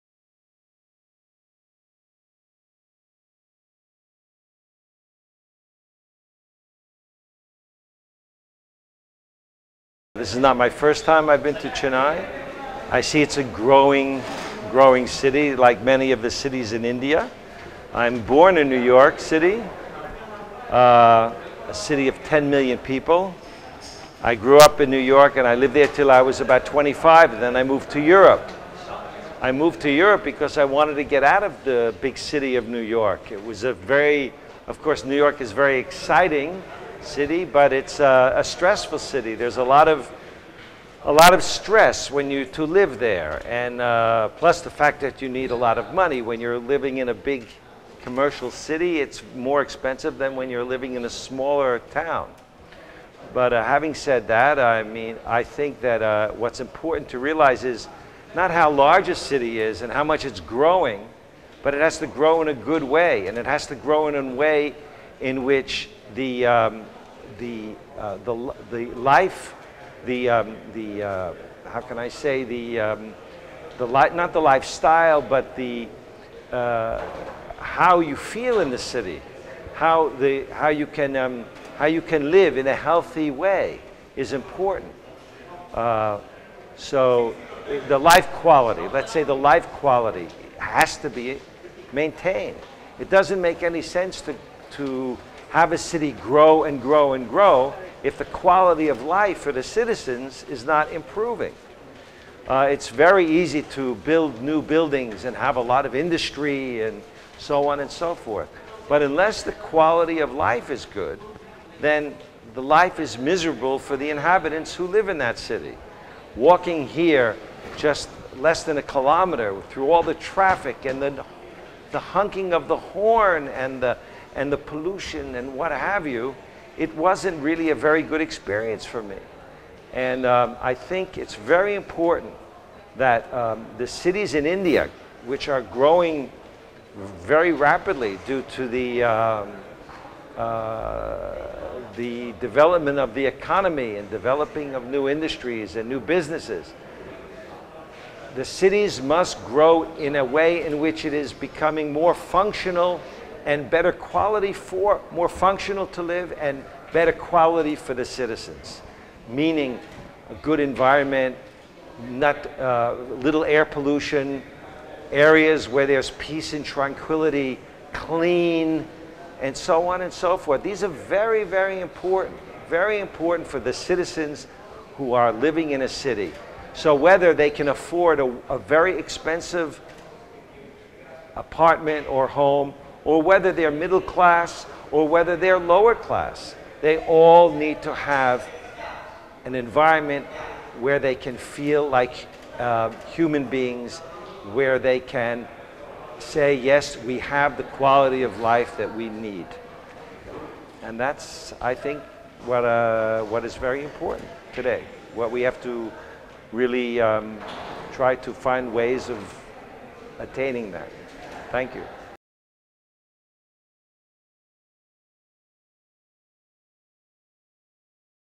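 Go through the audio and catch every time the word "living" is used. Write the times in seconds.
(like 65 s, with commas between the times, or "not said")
46 s, 50 s, 175 s.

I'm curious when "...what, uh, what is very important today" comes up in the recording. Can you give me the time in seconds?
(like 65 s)
202 s.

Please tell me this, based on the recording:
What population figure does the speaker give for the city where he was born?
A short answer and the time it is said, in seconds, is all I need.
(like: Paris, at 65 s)
10 million, at 22 s.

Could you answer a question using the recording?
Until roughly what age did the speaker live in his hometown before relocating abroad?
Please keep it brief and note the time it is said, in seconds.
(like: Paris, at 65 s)
25, at 26 s.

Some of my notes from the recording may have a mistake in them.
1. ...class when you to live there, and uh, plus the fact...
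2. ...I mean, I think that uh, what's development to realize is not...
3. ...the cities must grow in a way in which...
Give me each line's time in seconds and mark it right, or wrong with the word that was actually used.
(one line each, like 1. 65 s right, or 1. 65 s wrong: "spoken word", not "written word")
1. 41 s wrong: "stress", not "class"
2. 54 s wrong: "important", not "development"
3. 148 s right.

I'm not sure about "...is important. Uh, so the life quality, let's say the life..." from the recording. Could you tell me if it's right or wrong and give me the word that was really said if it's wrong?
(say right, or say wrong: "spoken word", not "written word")
right.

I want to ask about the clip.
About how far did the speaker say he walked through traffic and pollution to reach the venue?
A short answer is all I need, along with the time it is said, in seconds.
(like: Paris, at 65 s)
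less than a kilometer, at 118 s.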